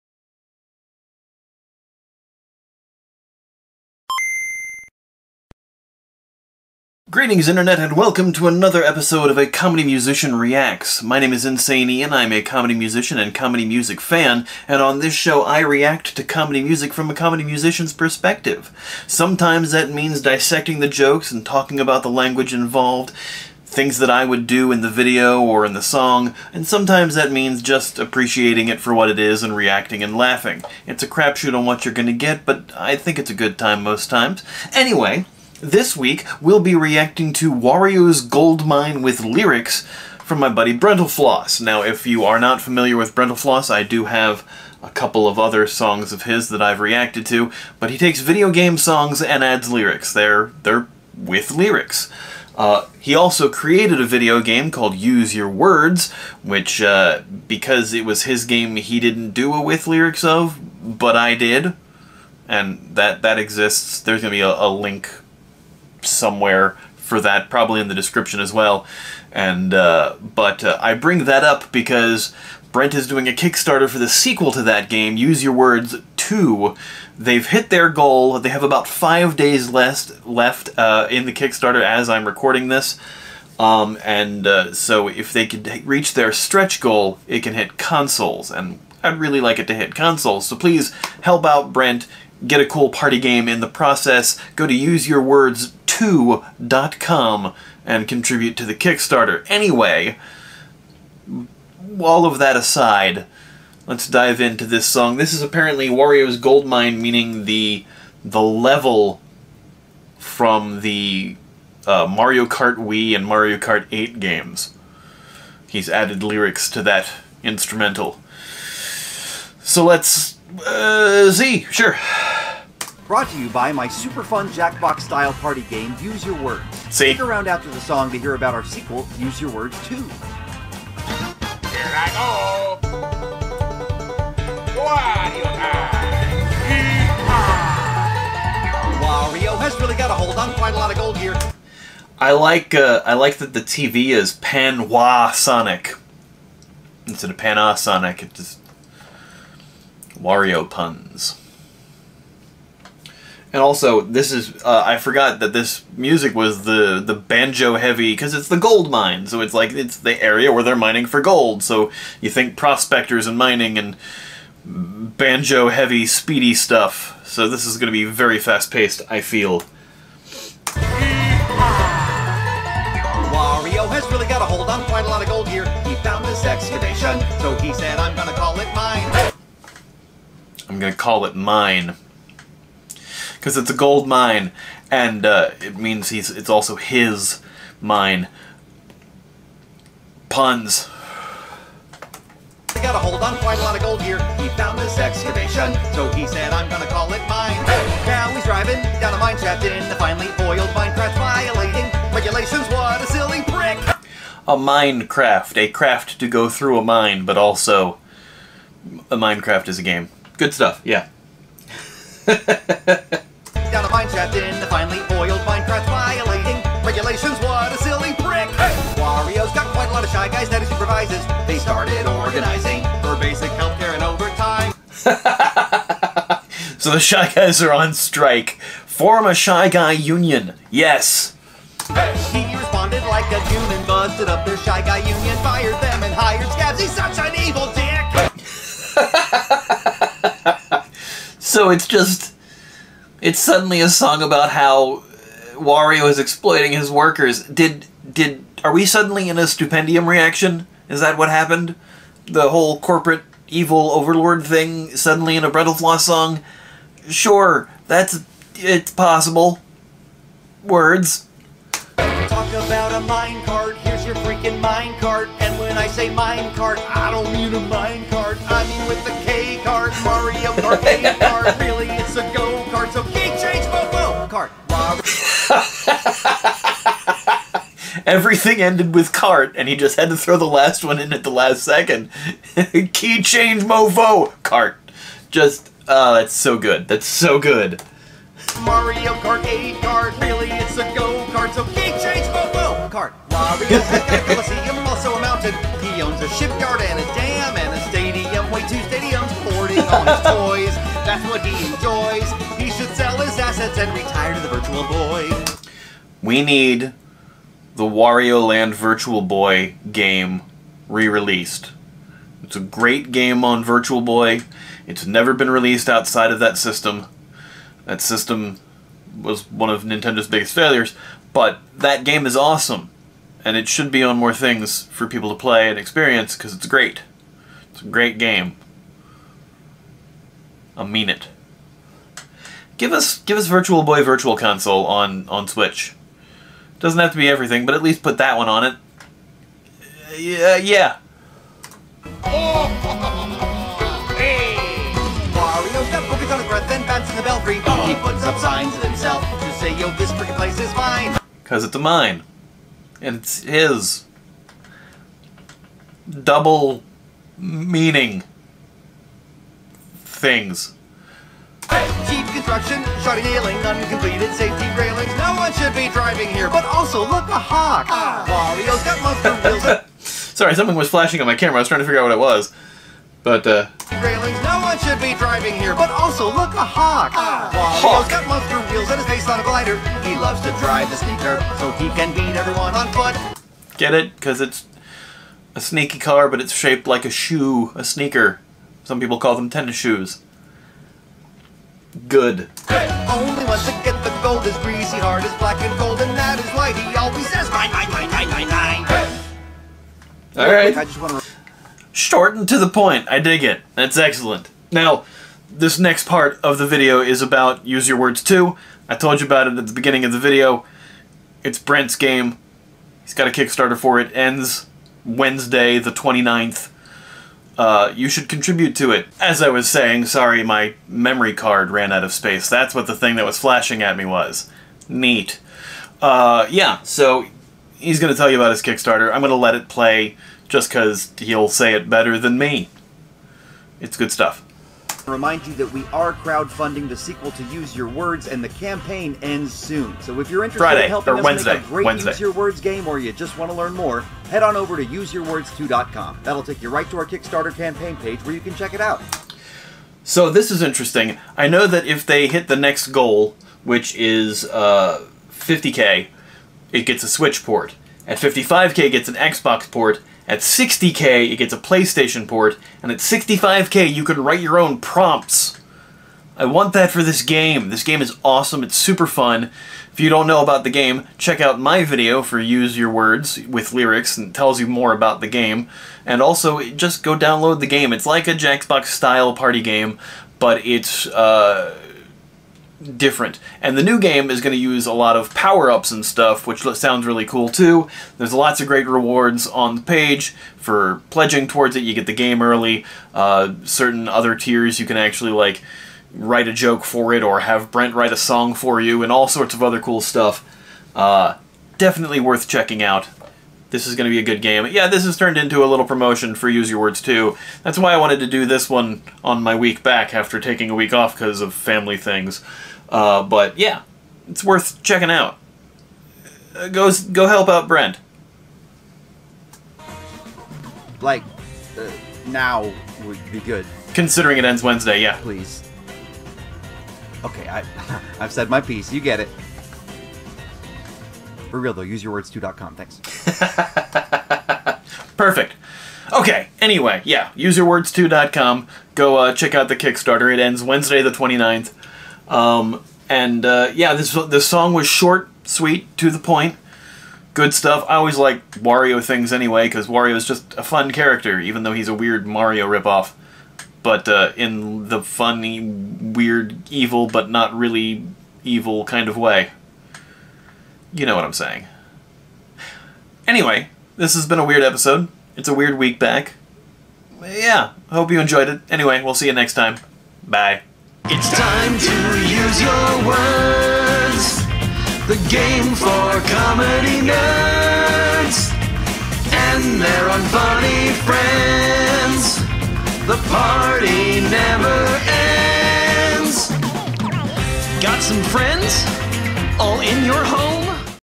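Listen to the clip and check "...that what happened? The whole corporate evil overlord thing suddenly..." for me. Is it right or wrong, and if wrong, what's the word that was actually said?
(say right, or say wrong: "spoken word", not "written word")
right.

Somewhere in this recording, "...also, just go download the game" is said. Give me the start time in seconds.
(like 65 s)
476 s.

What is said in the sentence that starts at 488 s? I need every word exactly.
There's lots of great rewards on the page for pledging towards it.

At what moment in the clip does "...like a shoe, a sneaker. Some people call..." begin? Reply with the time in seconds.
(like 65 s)
386 s.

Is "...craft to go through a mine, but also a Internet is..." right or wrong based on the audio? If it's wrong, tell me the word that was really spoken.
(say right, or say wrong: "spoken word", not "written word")
wrong: "Minecraft", not "Internet".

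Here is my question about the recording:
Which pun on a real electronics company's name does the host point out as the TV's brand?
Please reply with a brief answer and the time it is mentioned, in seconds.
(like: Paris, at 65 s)
Pan Sonic, at 144 s.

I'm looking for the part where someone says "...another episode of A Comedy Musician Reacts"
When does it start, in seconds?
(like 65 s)
8 s.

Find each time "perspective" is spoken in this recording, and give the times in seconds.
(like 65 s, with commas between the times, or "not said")
17 s.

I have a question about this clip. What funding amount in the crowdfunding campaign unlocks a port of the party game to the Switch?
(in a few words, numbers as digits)
50k.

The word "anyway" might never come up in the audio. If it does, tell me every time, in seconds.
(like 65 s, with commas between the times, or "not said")
34 s, 99 s, 536 s, 549 s, 563 s, 568 s.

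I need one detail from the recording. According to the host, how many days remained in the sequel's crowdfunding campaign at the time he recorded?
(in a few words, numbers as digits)
5.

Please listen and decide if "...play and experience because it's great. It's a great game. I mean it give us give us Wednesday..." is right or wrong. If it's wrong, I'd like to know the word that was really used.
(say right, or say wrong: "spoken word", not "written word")
wrong: "Virtual", not "Wednesday".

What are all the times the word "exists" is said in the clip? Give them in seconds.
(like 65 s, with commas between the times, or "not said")
63 s.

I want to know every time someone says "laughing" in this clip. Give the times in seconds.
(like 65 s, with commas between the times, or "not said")
30 s.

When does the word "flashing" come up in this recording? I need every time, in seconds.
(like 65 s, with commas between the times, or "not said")
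370 s, 423 s.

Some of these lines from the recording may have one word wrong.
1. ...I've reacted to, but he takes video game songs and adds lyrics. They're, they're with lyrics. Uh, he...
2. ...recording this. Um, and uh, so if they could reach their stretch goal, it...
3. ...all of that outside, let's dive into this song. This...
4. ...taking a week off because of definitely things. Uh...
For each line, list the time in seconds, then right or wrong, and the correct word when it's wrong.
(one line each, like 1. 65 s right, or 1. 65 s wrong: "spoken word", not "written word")
1. 46 s right
2. 82 s right
3. 101 s wrong: "aside", not "outside"
4. 510 s wrong: "family", not "definitely".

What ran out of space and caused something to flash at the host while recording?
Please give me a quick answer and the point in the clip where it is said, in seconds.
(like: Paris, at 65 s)
Memory card, at 420 s.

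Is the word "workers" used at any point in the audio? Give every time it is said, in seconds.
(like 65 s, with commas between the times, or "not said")
246 s.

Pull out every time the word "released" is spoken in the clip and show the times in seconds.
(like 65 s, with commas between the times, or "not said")
310 s, 315 s.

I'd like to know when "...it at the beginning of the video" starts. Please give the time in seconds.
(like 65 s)
409 s.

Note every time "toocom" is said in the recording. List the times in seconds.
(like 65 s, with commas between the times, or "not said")
532 s.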